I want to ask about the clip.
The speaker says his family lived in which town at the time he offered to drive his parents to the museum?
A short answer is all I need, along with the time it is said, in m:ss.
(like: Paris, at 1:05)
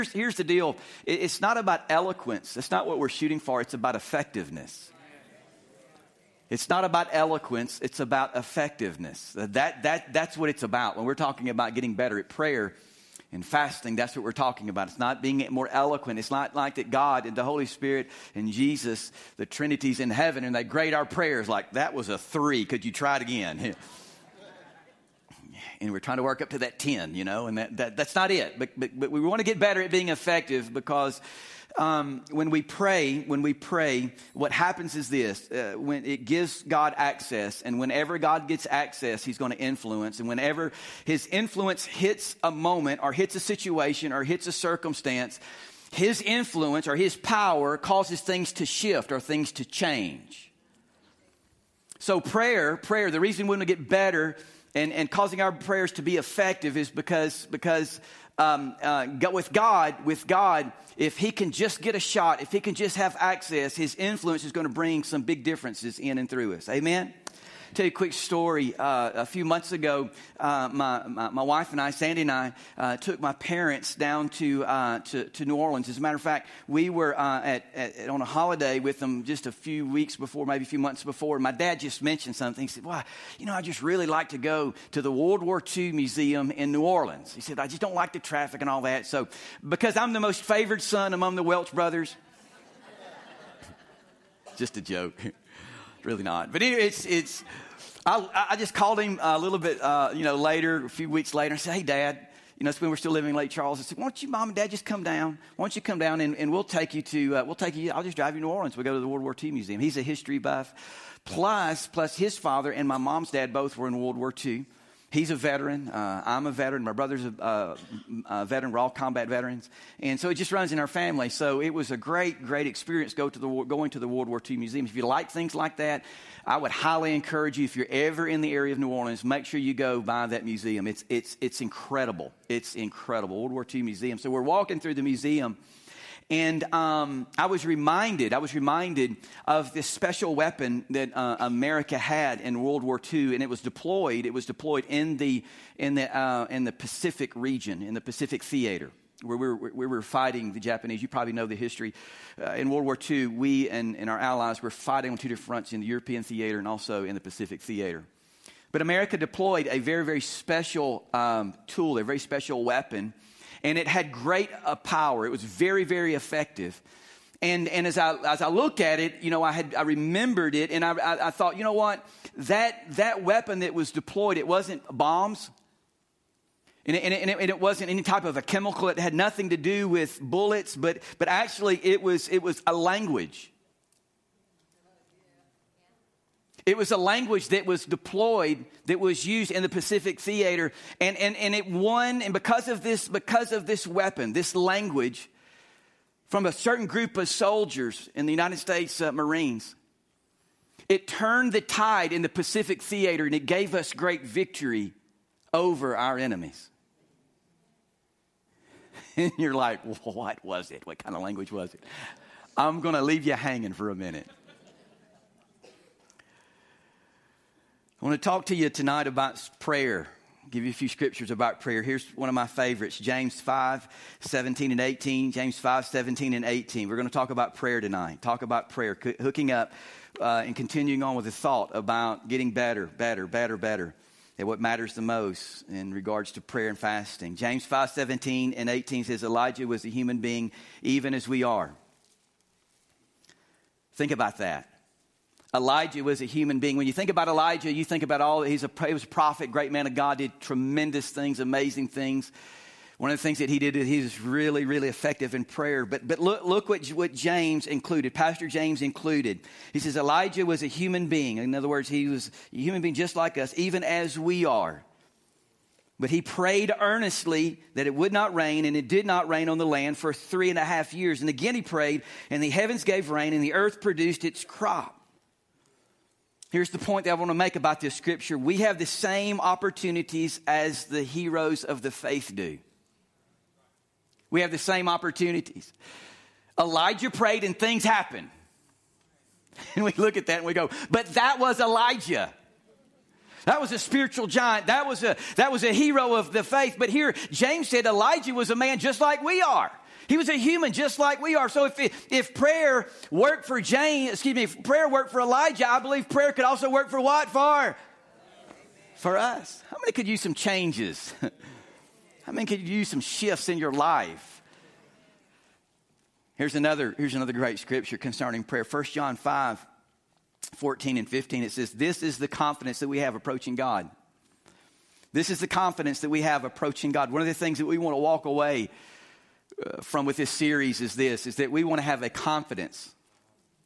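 Lake Charles, at 1:43.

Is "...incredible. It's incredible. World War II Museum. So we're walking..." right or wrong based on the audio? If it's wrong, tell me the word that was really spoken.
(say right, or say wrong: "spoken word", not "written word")
right.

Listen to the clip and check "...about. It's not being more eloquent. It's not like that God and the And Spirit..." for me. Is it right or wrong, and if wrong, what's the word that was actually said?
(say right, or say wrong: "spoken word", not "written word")
wrong: "Holy", not "And".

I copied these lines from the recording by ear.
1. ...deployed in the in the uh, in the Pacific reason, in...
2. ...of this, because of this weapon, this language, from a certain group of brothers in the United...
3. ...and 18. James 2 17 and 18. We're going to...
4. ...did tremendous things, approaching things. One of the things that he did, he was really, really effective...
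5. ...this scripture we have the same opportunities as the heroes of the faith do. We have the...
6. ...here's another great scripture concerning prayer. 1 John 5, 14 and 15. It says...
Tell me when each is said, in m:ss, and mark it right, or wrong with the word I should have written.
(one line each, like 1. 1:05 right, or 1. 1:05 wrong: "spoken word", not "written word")
1. 2:24 wrong: "region", not "reason"
2. 3:12 wrong: "soldiers", not "brothers"
3. 3:44 wrong: "5", not "2"
4. 4:10 wrong: "amazing", not "approaching"
5. 4:37 right
6. 5:16 right.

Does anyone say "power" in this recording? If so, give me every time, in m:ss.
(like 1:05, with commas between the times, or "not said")
0:47, 2:44.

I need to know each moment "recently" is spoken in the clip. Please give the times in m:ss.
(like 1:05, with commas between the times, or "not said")
not said.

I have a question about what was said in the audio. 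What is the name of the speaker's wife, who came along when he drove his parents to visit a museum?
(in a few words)
Sandy.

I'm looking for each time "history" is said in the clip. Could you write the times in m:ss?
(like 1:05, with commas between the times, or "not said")
1:50, 2:31.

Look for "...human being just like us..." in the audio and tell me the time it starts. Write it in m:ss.
4:22.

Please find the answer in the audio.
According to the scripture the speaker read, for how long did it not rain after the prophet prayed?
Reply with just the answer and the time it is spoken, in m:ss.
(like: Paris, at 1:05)
3.5 years, at 4:30.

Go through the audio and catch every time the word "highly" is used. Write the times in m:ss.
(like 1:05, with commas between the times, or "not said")
2:06.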